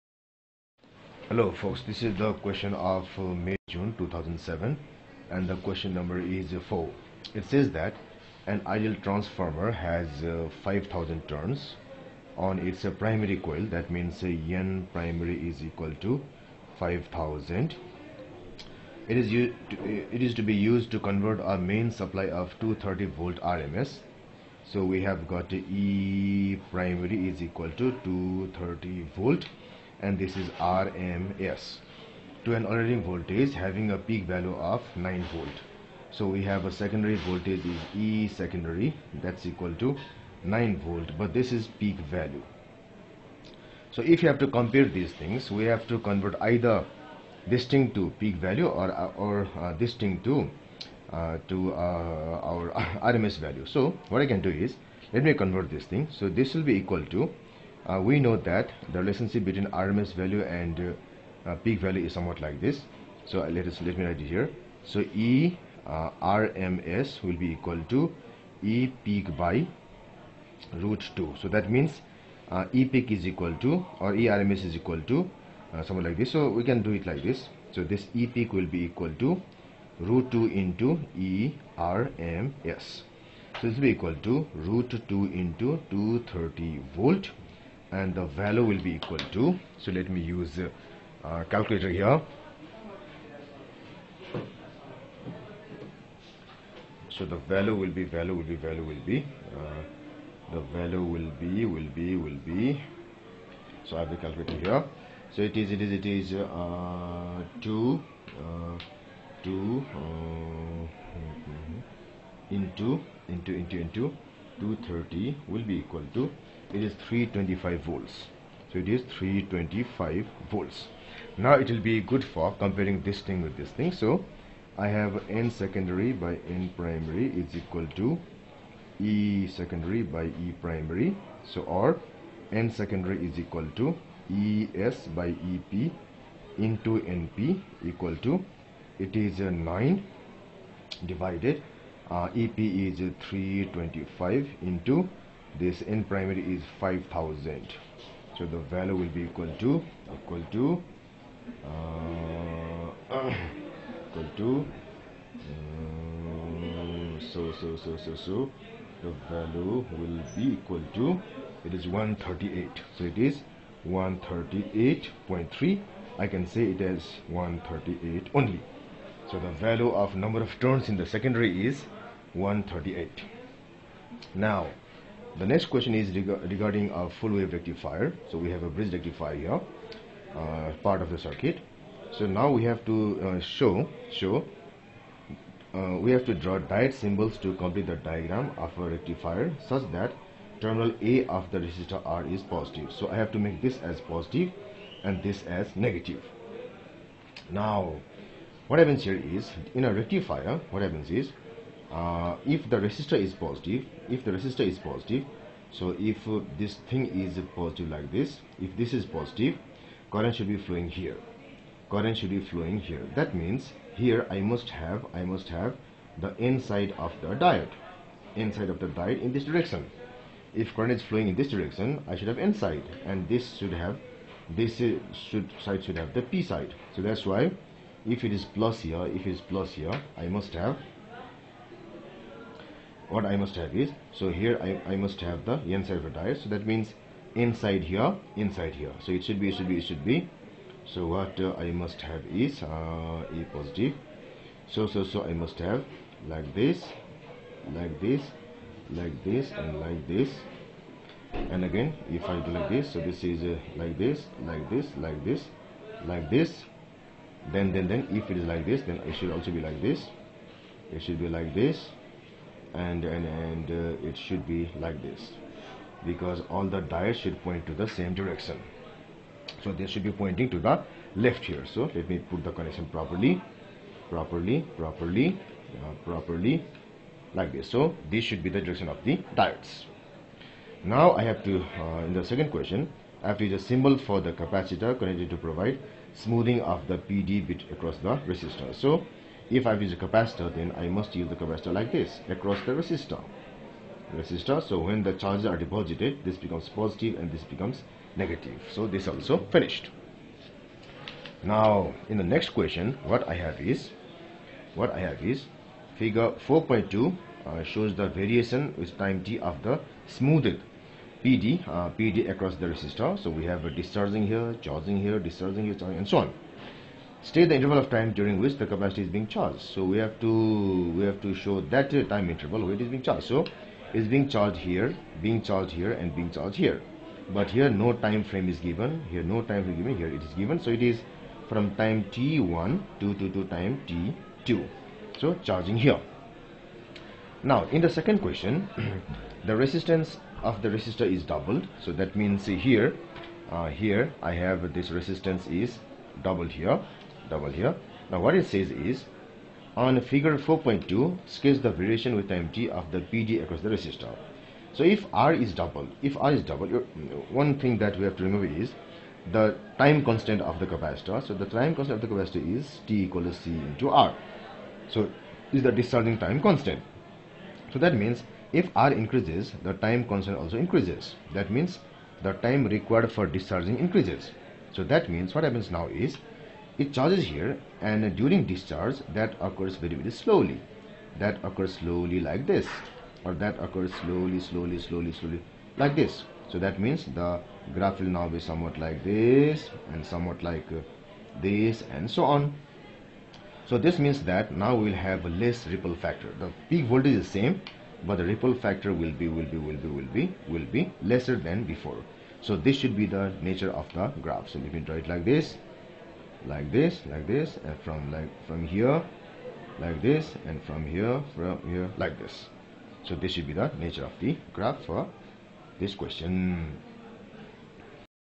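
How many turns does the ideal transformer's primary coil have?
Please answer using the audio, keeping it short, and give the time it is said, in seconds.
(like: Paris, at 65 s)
5000, at 10 s.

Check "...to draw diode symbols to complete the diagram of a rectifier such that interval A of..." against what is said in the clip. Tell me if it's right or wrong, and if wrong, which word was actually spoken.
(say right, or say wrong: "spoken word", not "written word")
wrong: "terminal", not "interval".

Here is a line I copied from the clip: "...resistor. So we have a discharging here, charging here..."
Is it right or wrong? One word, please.
right.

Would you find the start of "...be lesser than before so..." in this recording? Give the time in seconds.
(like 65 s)
400 s.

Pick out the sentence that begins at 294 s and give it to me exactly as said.
Resistor, so when the charges are deposited, this becomes positive and this becomes negative.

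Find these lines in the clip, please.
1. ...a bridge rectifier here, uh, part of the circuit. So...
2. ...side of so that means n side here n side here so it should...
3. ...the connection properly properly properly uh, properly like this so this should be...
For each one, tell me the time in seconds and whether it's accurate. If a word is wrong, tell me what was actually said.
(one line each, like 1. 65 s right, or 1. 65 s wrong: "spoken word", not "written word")
1. 178 s right
2. 235 s right
3. 272 s right.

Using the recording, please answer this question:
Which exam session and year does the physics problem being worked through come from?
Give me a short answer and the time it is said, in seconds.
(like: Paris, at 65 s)
May-June 2007, at 3 s.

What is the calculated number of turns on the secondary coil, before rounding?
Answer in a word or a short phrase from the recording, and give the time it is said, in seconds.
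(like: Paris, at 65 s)
138.3, at 163 s.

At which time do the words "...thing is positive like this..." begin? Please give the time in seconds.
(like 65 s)
206 s.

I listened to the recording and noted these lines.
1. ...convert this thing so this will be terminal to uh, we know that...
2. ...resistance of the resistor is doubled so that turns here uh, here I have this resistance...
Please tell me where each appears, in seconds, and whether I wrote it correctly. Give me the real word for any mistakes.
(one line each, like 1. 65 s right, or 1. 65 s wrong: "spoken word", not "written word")
1. 55 s wrong: "equal", not "terminal"
2. 339 s wrong: "means", not "turns".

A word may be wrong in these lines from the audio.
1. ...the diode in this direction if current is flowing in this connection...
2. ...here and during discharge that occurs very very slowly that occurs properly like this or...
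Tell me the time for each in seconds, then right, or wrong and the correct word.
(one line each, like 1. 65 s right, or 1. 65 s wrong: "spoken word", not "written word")
1. 218 s wrong: "direction", not "connection"
2. 377 s wrong: "slowly", not "properly".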